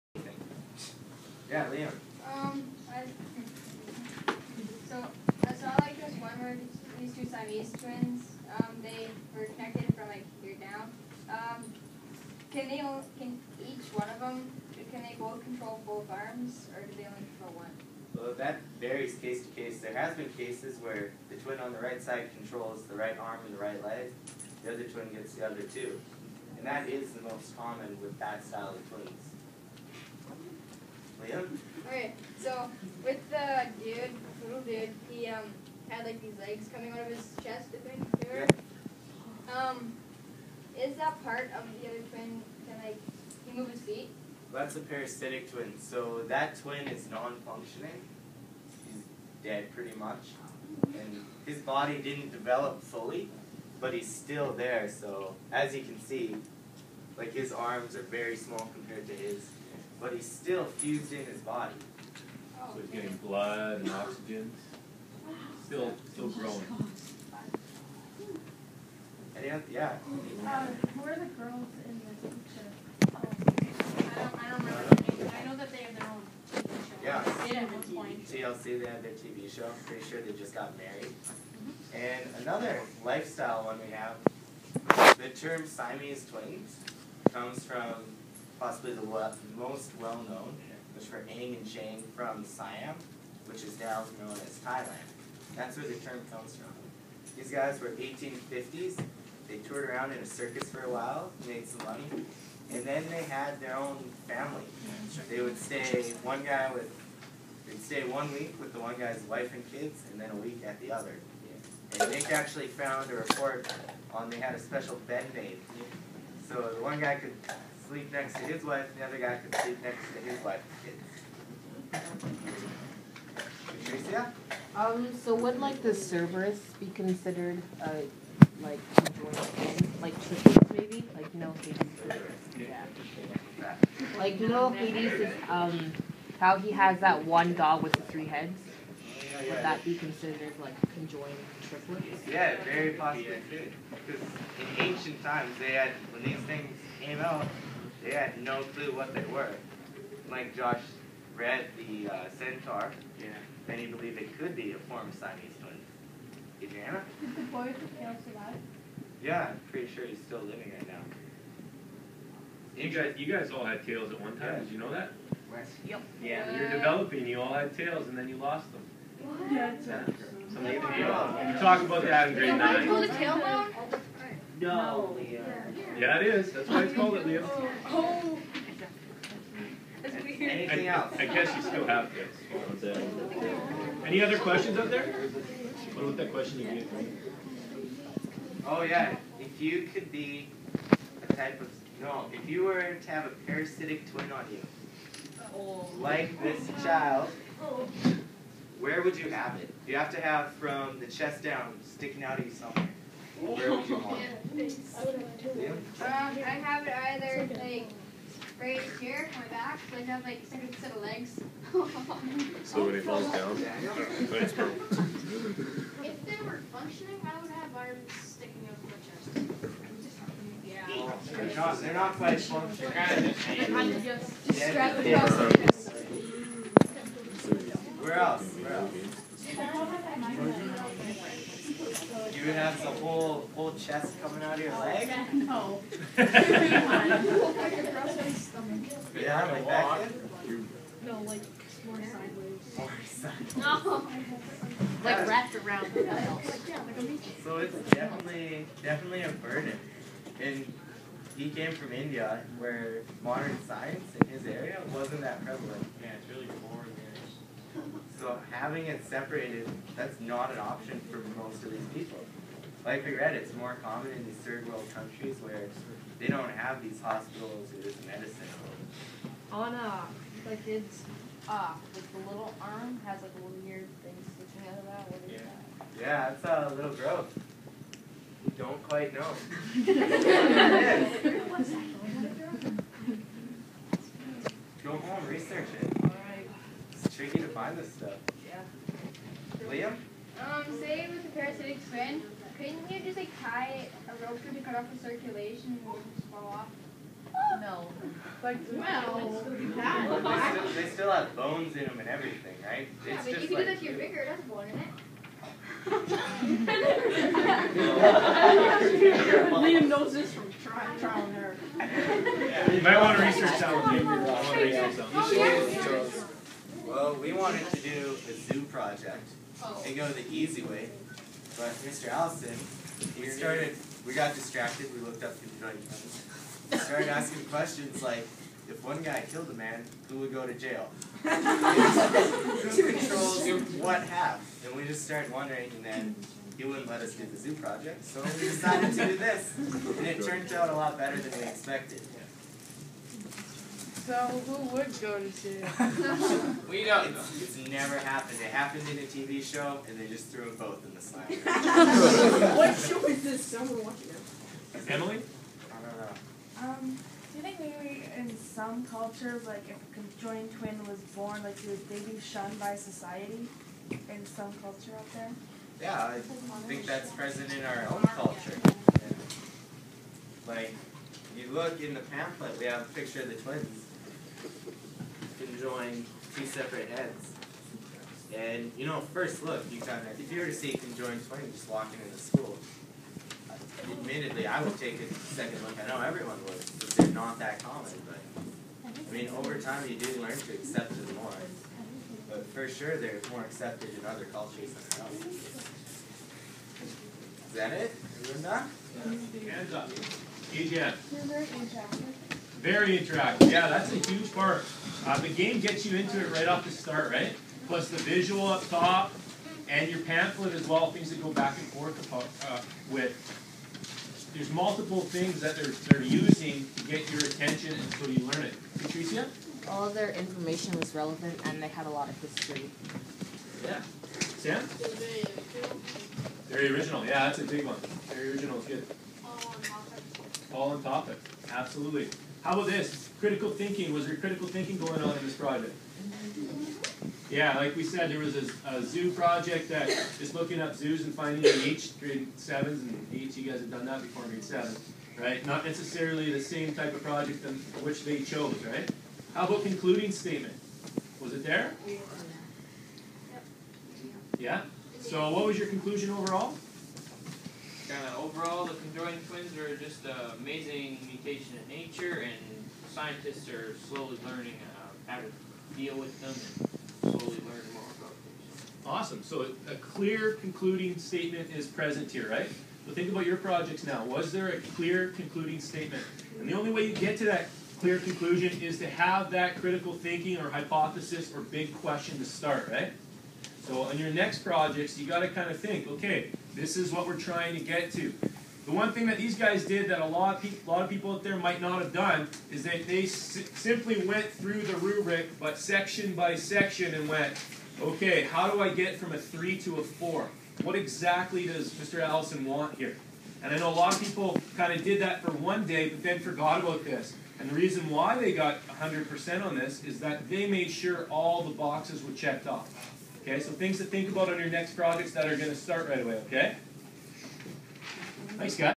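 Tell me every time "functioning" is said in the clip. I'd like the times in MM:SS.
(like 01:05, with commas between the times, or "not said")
00:47, 03:36, 03:42.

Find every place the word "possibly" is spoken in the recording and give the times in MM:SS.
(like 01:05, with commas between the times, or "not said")
01:28, 02:22.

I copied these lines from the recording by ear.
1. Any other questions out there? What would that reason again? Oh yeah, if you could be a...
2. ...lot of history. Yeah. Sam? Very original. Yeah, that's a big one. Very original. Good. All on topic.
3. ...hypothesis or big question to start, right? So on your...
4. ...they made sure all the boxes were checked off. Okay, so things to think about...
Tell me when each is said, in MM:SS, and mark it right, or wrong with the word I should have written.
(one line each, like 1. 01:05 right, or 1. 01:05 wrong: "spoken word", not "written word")
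1. 03:04 wrong: "question", not "reason"
2. 07:01 right
3. 08:00 right
4. 08:30 right.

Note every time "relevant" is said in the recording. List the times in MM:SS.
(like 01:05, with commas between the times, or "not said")
07:00.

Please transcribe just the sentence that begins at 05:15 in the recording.
Oh, well, we wanted to do a zoo project oh.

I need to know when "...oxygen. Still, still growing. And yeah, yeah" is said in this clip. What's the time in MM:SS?
01:03.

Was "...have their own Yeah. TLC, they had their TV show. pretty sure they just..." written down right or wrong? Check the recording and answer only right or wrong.
right.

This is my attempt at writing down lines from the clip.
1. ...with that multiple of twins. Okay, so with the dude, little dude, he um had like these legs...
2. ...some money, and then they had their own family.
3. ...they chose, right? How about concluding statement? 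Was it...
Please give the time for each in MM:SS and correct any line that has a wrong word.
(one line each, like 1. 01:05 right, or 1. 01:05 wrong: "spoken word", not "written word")
1. 00:28 wrong: "style", not "multiple"
2. 01:41 right
3. 07:28 right.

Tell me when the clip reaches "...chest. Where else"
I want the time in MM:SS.
03:45.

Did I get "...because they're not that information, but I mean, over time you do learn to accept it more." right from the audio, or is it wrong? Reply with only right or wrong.
wrong.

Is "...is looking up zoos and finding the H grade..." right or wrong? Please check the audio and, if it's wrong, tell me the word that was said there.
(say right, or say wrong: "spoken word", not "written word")
right.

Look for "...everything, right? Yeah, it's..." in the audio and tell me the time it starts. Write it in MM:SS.
05:02.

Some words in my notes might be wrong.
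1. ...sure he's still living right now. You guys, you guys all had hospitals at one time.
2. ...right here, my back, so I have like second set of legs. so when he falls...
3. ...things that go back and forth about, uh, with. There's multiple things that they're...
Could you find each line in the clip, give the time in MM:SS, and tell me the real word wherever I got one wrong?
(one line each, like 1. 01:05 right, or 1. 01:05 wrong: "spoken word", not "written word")
1. 02:39 wrong: "tails", not "hospitals"
2. 03:28 right
3. 06:50 right.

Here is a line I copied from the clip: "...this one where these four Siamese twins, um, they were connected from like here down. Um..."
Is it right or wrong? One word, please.
wrong.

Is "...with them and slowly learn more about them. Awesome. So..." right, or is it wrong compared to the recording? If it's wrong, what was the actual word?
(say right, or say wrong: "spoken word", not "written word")
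right.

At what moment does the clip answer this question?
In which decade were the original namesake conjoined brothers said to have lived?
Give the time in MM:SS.
01:37.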